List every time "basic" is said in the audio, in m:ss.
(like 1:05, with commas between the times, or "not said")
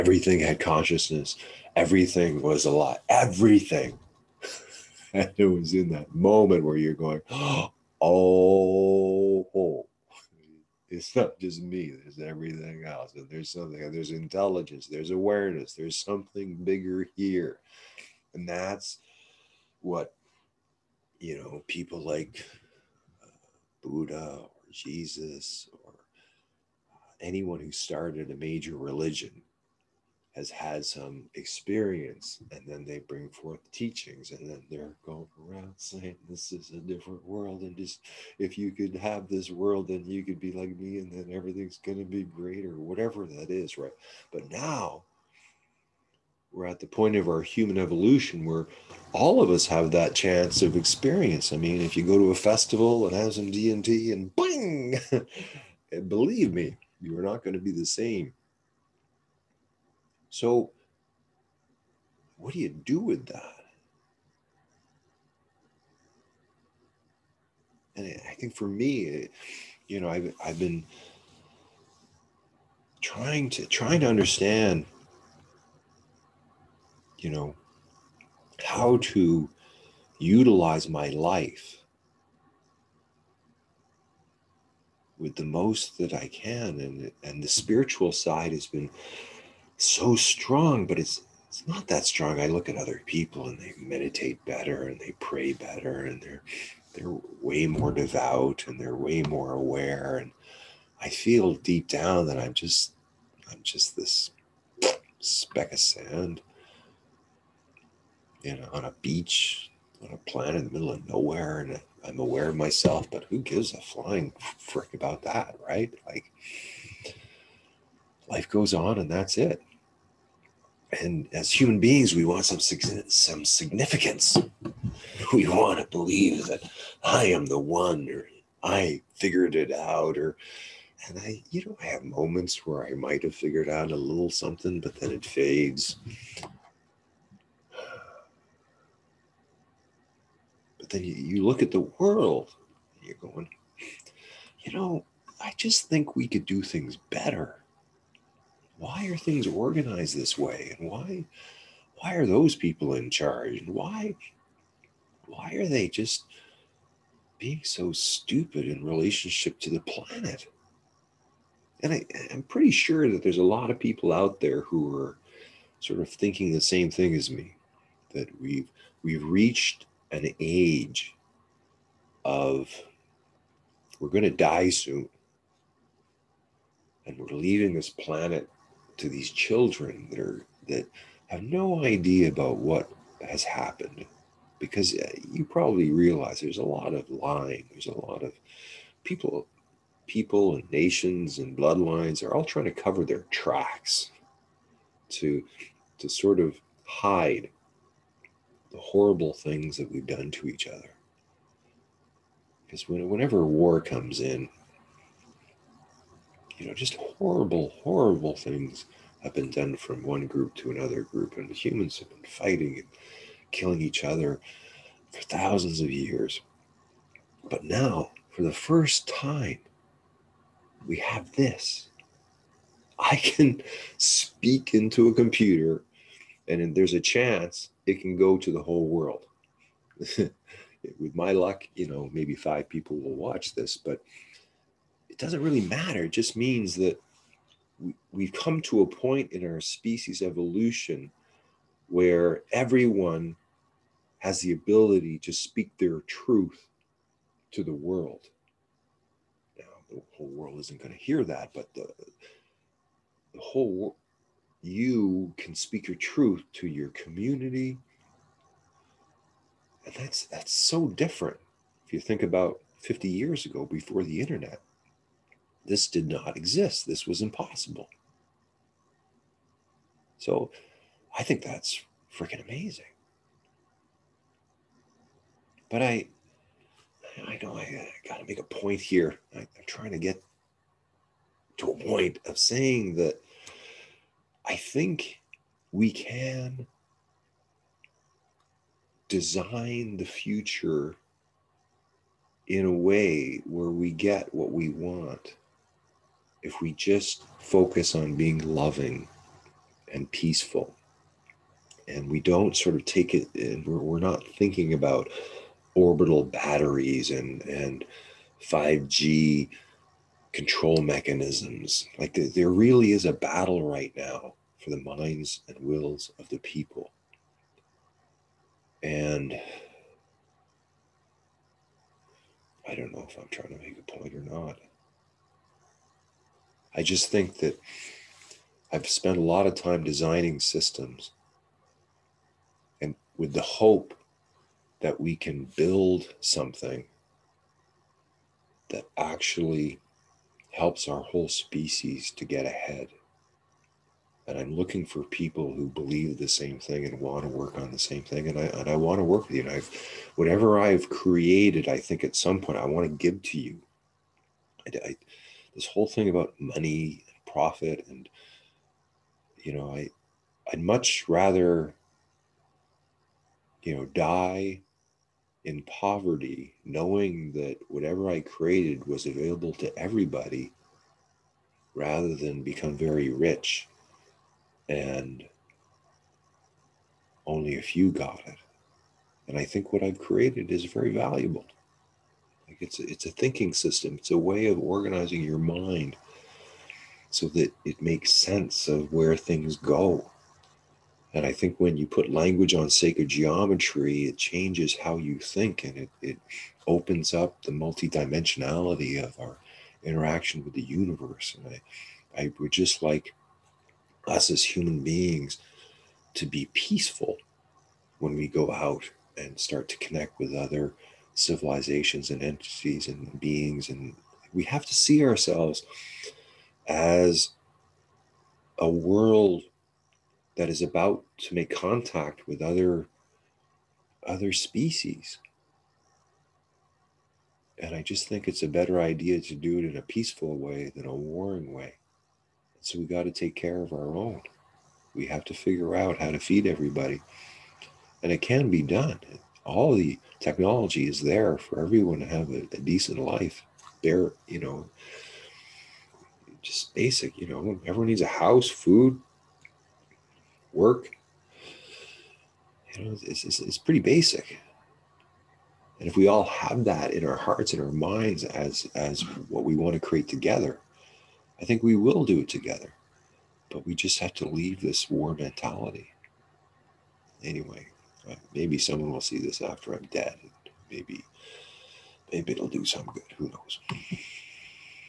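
7:26, 7:33.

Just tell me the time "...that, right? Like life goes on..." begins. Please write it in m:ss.
1:55.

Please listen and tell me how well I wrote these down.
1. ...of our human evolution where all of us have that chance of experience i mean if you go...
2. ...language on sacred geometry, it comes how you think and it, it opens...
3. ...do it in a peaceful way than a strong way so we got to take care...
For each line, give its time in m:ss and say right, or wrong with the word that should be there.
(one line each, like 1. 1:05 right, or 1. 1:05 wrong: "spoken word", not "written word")
1. 0:47 right
2. 6:32 wrong: "changes", not "comes"
3. 7:09 wrong: "warring", not "strong".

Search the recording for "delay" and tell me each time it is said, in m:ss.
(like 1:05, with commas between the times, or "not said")
not said.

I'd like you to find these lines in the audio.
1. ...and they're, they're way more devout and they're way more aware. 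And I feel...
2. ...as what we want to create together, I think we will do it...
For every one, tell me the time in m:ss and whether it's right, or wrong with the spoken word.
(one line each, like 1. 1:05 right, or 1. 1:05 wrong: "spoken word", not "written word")
1. 1:36 right
2. 7:38 right.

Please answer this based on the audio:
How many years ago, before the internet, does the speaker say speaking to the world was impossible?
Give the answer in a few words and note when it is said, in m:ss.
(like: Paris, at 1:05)
50 years, at 4:22.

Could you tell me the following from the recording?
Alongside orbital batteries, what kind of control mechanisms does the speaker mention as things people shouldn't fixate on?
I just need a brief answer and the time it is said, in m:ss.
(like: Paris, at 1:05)
5G, at 5:08.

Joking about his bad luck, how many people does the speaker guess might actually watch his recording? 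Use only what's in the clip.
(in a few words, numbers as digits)
5.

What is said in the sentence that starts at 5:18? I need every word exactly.
And I don't know if I'm trying to make a point or not.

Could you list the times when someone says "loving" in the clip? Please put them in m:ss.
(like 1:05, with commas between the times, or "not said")
4:58.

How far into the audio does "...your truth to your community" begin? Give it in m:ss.
4:15.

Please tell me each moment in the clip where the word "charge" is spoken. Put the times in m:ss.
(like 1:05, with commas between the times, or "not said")
2:33.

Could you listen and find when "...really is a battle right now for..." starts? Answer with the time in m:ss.
5:12.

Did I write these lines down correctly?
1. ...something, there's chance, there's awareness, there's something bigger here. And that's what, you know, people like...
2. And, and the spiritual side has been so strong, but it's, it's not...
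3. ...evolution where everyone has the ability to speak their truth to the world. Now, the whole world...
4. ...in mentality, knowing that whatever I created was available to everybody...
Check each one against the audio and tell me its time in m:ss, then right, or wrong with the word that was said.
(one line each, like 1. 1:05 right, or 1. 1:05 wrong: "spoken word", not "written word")
1. 0:13 wrong: "intelligence", not "chance"
2. 1:26 right
3. 4:00 right
4. 6:05 wrong: "poverty", not "mentality".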